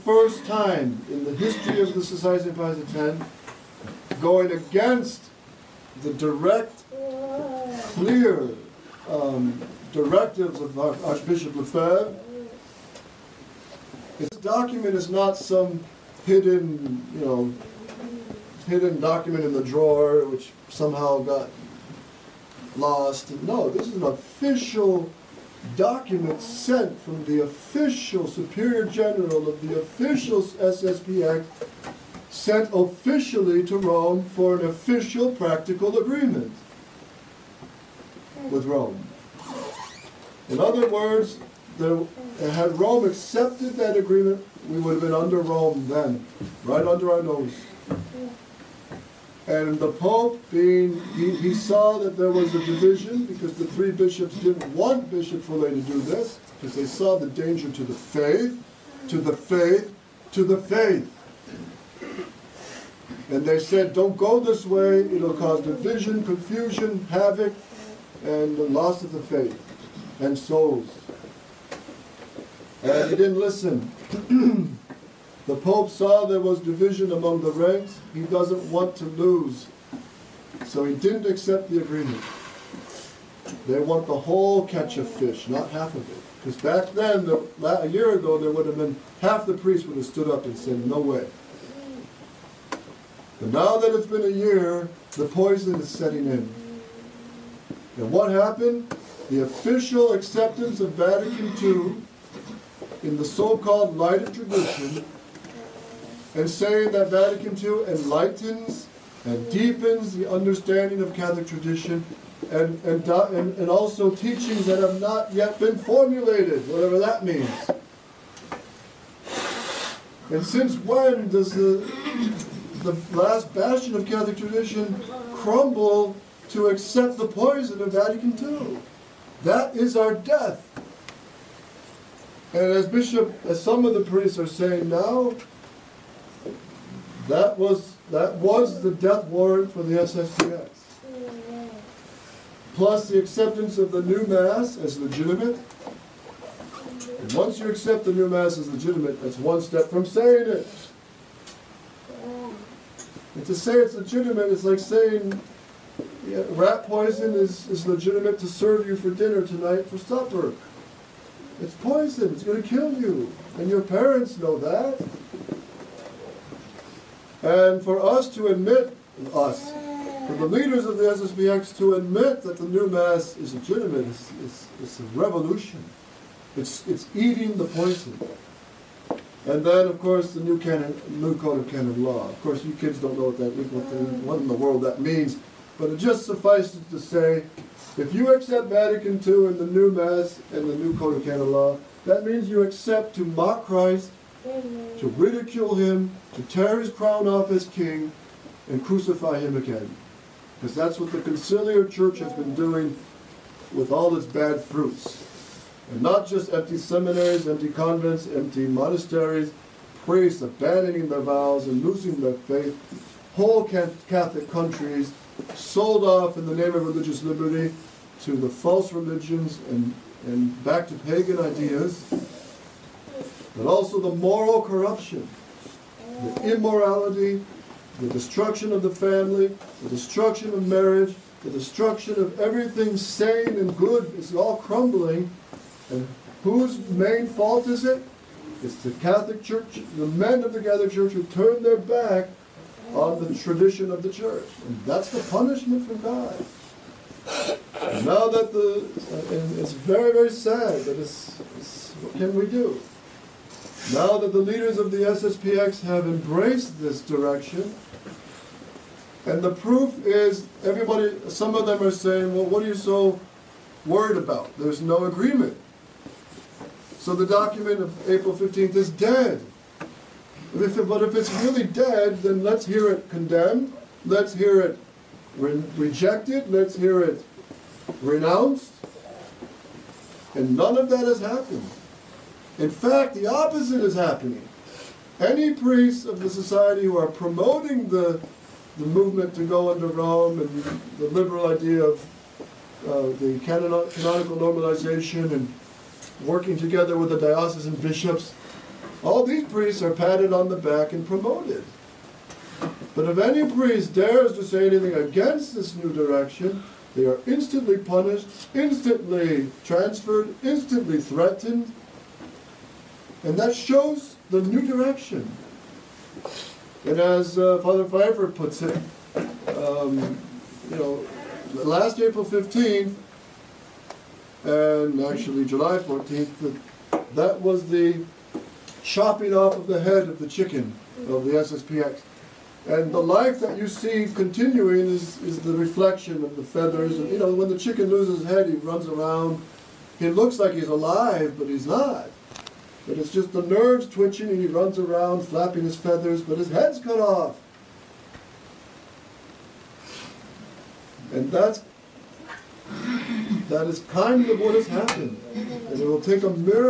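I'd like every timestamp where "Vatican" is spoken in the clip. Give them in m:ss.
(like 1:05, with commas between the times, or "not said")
1:40, 1:47, 2:07, 3:08.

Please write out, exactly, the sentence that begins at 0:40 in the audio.
In other words, there, had Rome accepted that agreement, we would have been under Rome then, right under our nose.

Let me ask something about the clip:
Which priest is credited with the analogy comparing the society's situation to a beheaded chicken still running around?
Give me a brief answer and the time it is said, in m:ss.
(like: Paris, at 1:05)
Father Pfeiffer, at 5:17.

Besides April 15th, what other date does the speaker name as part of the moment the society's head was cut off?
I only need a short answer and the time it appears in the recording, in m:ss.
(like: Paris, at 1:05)
July 14th, at 5:25.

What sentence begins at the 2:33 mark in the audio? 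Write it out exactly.
And to say it's legitimate is like saying yeah, rat poison is, is legitimate to serve you for dinner tonight for supper.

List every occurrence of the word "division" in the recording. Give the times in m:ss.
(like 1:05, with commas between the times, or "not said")
0:52, 1:05, 1:16.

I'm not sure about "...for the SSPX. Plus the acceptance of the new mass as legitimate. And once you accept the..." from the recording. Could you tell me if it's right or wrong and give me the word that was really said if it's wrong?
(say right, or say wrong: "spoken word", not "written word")
right.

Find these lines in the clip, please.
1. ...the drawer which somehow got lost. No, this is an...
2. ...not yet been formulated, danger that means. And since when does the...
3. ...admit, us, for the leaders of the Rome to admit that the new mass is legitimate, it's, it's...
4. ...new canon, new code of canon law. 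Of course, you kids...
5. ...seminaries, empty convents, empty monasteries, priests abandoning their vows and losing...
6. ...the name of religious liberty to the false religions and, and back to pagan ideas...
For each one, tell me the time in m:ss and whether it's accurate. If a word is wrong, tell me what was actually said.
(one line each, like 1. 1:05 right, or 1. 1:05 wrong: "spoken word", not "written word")
1. 0:19 right
2. 1:55 wrong: "whatever", not "danger"
3. 2:48 wrong: "SSPX", not "Rome"
4. 3:00 right
5. 3:26 right
6. 3:36 right.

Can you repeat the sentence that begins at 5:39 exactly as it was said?
He looks like he's alive, but he's not.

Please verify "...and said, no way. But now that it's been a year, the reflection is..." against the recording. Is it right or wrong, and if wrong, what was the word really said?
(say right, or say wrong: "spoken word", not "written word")
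wrong: "poison", not "reflection".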